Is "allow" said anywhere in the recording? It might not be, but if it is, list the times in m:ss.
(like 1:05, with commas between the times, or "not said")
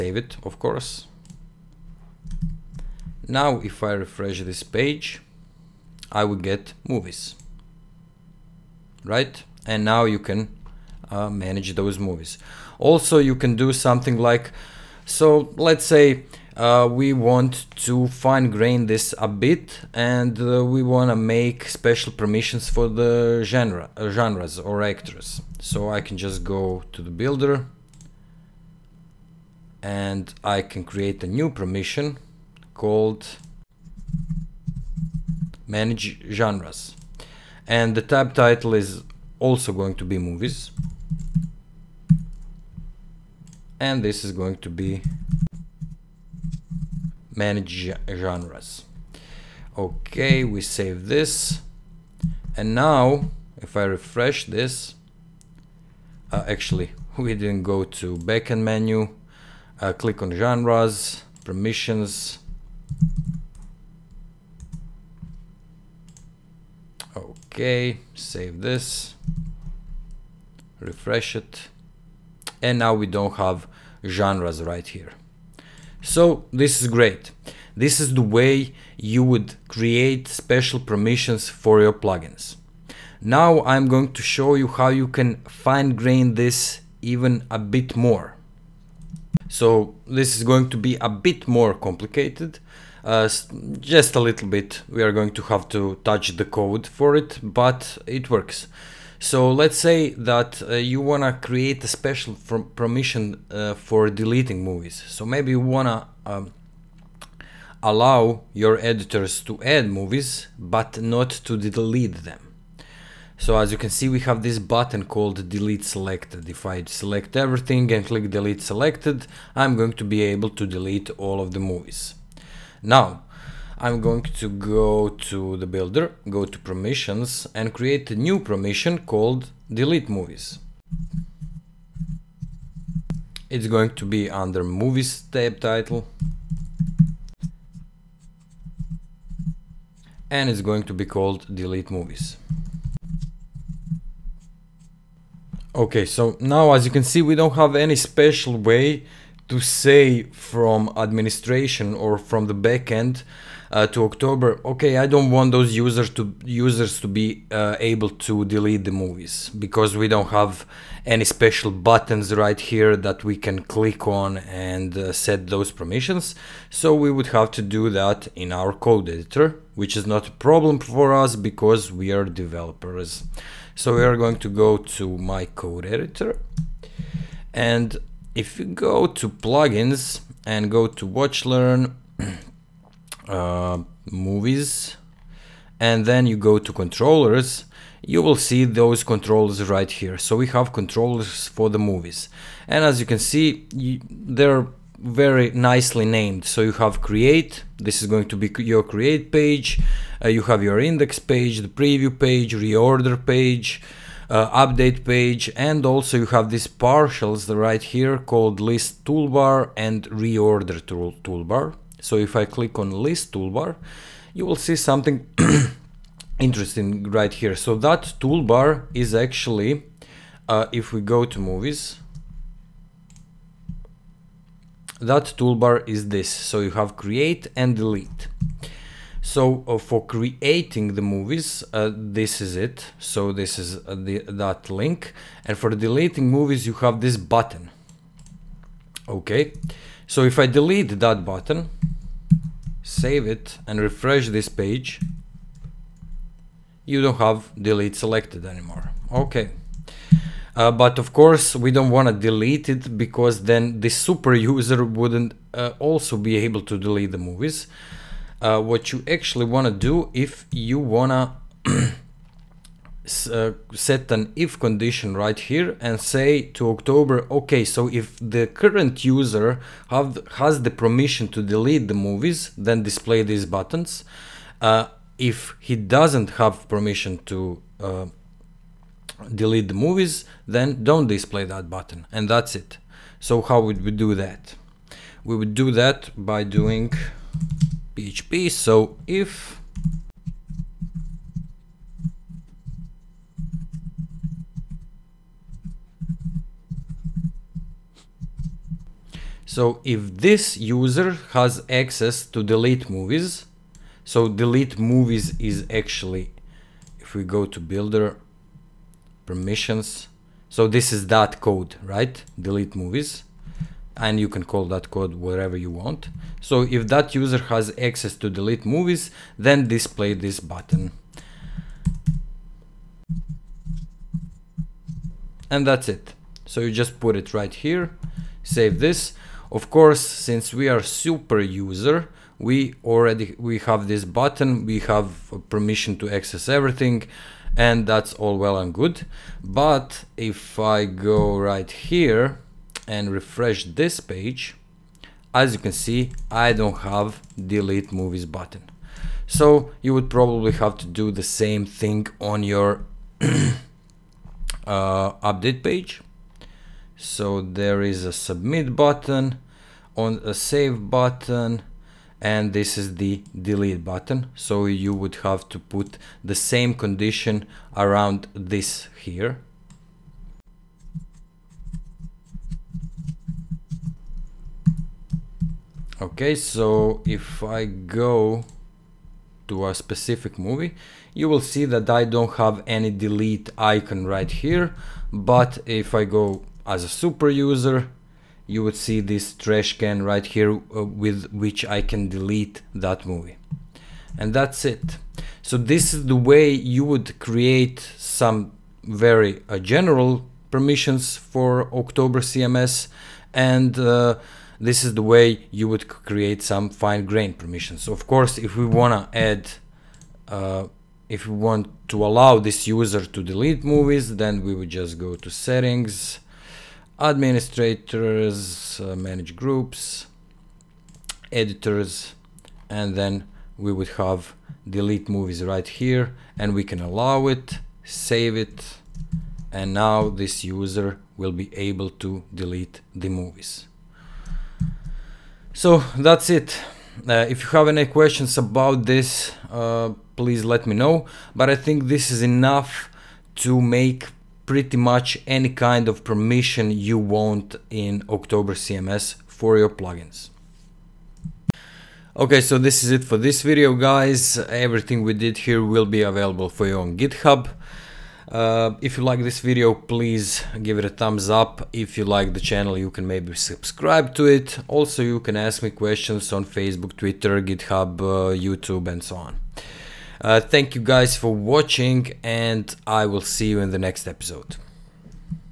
1:47, 6:52, 7:06.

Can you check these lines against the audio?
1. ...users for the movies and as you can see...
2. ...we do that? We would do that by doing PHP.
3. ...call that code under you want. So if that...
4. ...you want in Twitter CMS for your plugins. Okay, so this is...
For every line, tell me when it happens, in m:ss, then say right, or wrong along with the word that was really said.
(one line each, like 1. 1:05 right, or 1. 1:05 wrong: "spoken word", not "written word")
1. 3:10 wrong: "controllers", not "users"
2. 4:43 right
3. 5:14 wrong: "wherever", not "under"
4. 7:26 wrong: "October", not "Twitter".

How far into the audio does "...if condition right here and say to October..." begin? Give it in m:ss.
4:24.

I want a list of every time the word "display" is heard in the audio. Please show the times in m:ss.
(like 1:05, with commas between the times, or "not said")
4:32, 4:41, 5:19.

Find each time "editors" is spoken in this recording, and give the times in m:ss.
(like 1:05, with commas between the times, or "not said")
1:48, 2:49, 2:55, 7:01.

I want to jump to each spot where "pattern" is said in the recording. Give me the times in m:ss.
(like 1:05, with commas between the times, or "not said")
not said.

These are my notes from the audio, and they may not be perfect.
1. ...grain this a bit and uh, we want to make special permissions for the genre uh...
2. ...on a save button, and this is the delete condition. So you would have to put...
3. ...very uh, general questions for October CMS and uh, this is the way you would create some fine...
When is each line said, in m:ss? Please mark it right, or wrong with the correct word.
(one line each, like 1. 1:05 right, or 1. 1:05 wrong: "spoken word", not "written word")
1. 0:18 right
2. 5:59 wrong: "button", not "condition"
3. 6:38 wrong: "permissions", not "questions".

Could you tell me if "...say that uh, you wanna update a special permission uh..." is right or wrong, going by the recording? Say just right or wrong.
wrong.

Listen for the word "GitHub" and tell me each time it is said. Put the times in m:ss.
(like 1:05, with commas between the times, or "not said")
7:36, 7:47.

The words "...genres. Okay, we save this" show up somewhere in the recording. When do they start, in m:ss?
0:48.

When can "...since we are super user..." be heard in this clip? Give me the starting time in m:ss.
5:30.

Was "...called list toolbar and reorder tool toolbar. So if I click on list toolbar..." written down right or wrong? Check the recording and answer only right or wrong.
right.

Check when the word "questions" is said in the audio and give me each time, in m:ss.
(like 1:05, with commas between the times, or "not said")
7:17, 7:45.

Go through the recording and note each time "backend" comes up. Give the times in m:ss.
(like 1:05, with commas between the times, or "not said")
0:58, 2:32.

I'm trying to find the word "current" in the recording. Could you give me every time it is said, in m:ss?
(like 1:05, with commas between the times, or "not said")
4:28.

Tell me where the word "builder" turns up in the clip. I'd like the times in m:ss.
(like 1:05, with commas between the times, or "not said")
0:27, 2:05, 5:07.